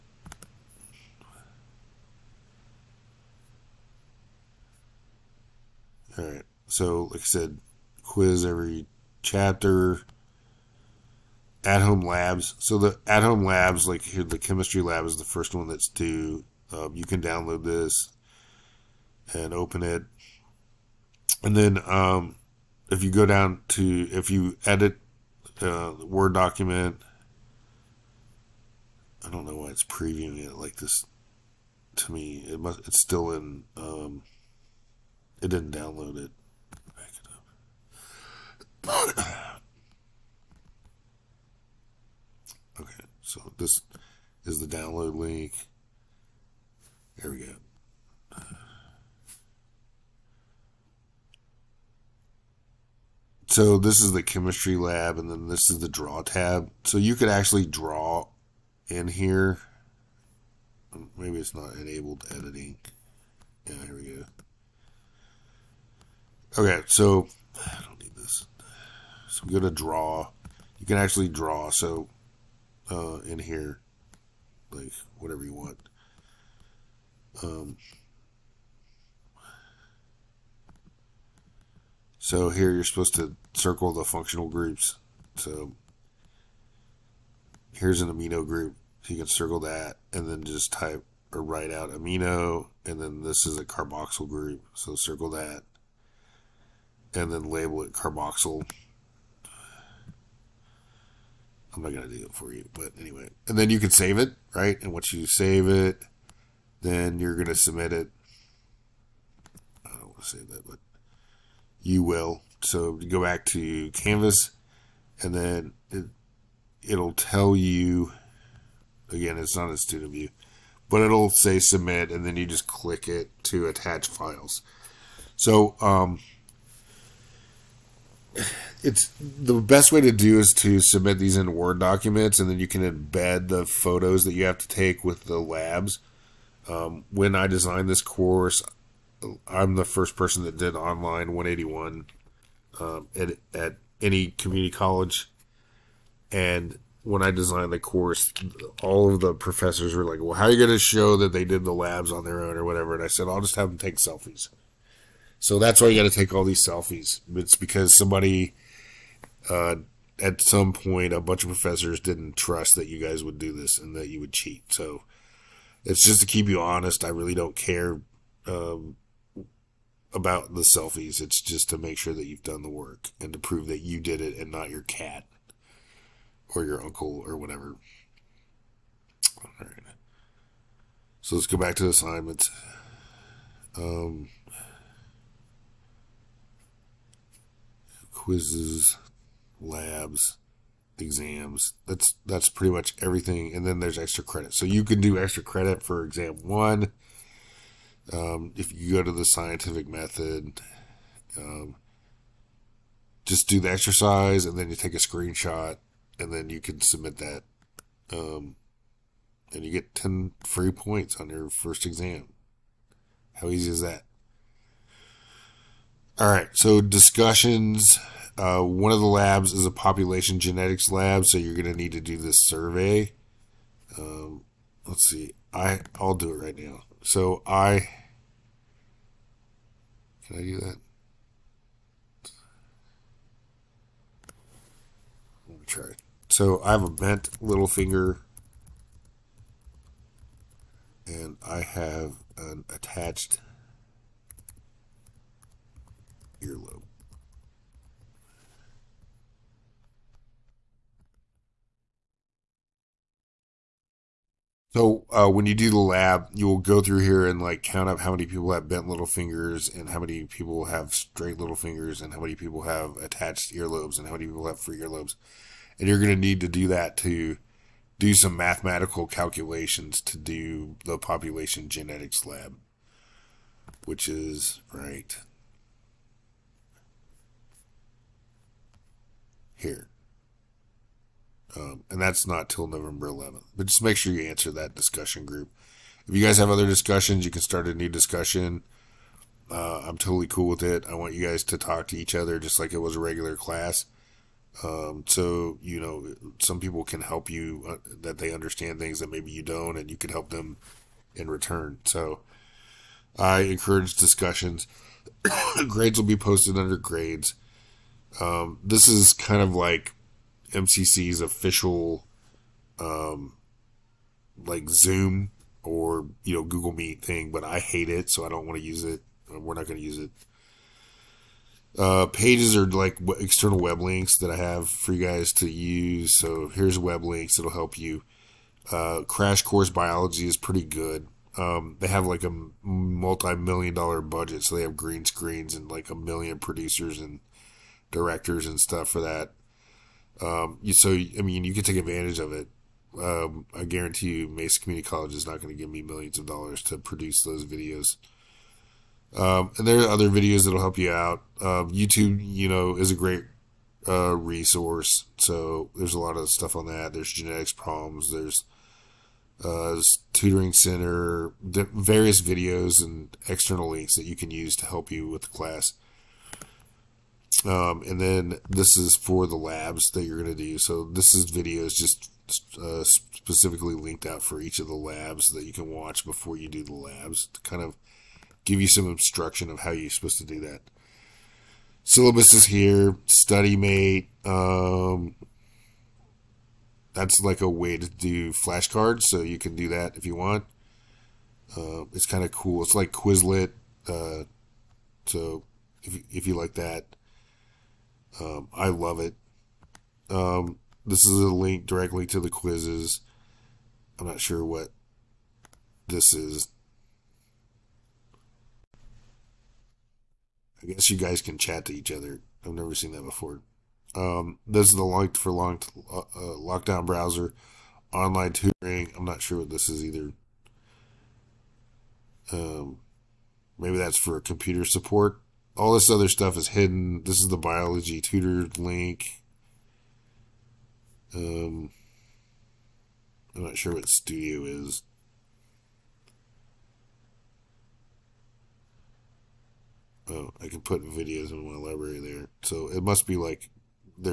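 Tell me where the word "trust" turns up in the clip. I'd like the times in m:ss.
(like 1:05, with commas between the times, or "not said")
2:42.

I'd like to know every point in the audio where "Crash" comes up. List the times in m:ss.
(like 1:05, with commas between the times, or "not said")
5:29.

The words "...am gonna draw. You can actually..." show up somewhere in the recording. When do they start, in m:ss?
1:09.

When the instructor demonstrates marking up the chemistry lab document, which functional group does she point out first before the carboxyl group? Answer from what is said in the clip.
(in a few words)
amino group.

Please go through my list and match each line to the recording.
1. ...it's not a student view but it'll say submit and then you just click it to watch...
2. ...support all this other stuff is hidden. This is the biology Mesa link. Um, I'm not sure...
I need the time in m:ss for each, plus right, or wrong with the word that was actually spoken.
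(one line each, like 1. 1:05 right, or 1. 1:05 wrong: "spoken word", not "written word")
1. 1:59 wrong: "attach", not "watch"
2. 7:04 wrong: "Tutor", not "Mesa".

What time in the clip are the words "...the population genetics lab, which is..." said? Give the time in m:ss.
4:30.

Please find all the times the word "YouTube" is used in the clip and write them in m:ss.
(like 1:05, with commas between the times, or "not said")
5:51.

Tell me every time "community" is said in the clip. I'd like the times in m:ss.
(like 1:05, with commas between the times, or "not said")
2:24, 5:44.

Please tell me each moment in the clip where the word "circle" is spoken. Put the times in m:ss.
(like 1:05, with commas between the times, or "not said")
1:23, 1:29, 1:34.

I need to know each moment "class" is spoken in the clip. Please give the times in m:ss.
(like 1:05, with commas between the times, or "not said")
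4:53, 6:05.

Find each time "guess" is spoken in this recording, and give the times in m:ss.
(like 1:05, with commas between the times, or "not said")
6:50.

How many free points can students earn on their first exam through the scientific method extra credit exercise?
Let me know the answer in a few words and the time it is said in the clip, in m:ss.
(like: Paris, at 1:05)
10, at 3:29.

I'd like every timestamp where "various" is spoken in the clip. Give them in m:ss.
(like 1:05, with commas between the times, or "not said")
6:01.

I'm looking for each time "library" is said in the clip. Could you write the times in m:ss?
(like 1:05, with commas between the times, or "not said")
7:21.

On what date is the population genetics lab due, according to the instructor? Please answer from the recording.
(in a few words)
November 11th.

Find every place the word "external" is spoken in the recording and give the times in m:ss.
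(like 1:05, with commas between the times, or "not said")
5:23, 6:03.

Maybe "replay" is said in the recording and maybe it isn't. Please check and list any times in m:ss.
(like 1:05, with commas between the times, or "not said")
not said.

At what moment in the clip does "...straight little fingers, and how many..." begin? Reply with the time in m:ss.
4:20.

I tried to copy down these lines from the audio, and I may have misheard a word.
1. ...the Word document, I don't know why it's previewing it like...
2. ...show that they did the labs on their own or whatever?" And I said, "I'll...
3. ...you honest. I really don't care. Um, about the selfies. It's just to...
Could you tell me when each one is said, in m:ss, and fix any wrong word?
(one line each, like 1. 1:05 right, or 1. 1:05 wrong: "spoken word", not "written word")
1. 0:25 right
2. 2:30 right
3. 2:46 right.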